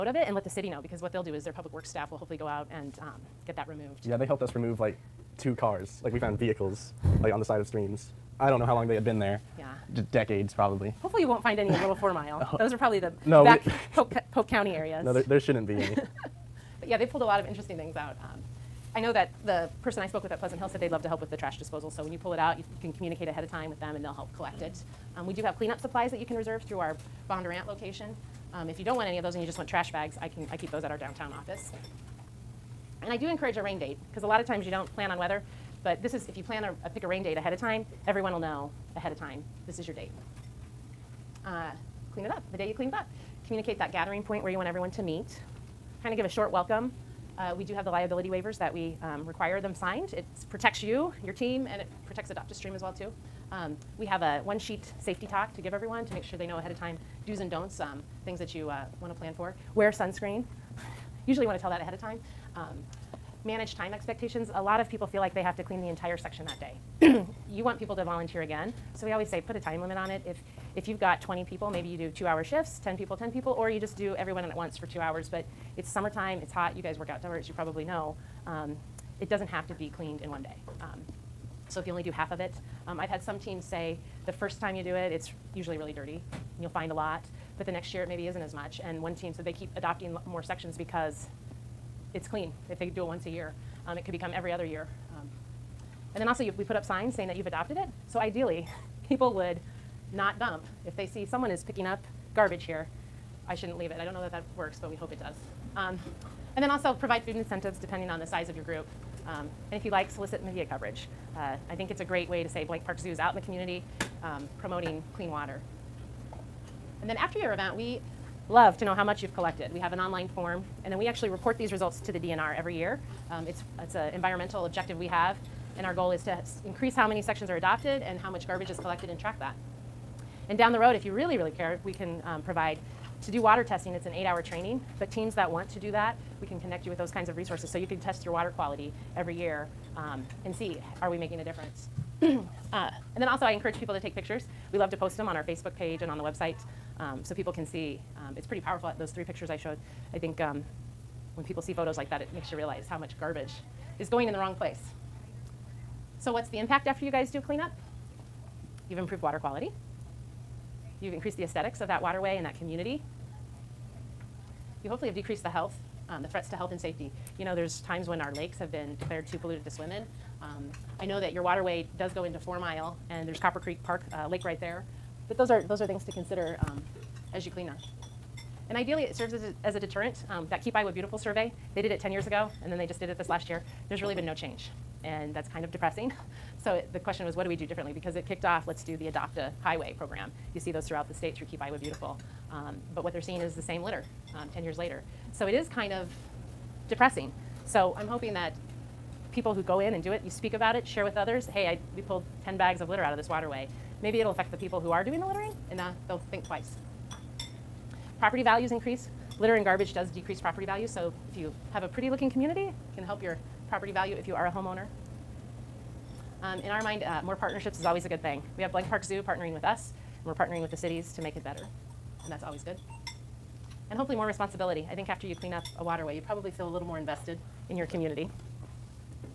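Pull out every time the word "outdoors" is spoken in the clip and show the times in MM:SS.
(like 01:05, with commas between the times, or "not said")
01:17.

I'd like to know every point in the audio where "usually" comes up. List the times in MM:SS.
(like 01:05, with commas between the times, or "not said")
01:01, 01:25.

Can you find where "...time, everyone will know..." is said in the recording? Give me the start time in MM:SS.
00:37.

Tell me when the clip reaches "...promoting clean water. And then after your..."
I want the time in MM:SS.
01:54.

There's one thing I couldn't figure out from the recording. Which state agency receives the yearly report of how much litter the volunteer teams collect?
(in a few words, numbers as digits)
DNR.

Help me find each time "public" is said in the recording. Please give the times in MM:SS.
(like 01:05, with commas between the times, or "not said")
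00:01.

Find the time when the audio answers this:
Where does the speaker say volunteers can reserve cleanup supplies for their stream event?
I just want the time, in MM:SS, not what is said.
00:27.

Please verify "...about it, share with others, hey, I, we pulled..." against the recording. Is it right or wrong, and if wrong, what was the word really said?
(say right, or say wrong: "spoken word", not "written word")
right.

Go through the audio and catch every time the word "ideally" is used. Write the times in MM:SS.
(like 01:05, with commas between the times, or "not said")
01:38, 02:58.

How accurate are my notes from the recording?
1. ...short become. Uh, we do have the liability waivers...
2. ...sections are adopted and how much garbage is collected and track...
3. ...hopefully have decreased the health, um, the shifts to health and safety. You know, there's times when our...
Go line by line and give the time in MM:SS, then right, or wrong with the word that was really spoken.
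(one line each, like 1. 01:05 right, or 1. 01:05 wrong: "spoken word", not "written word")
1. 00:46 wrong: "welcome", not "become"
2. 02:07 right
3. 02:44 wrong: "threats", not "shifts".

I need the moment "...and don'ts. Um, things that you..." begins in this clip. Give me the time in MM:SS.
00:57.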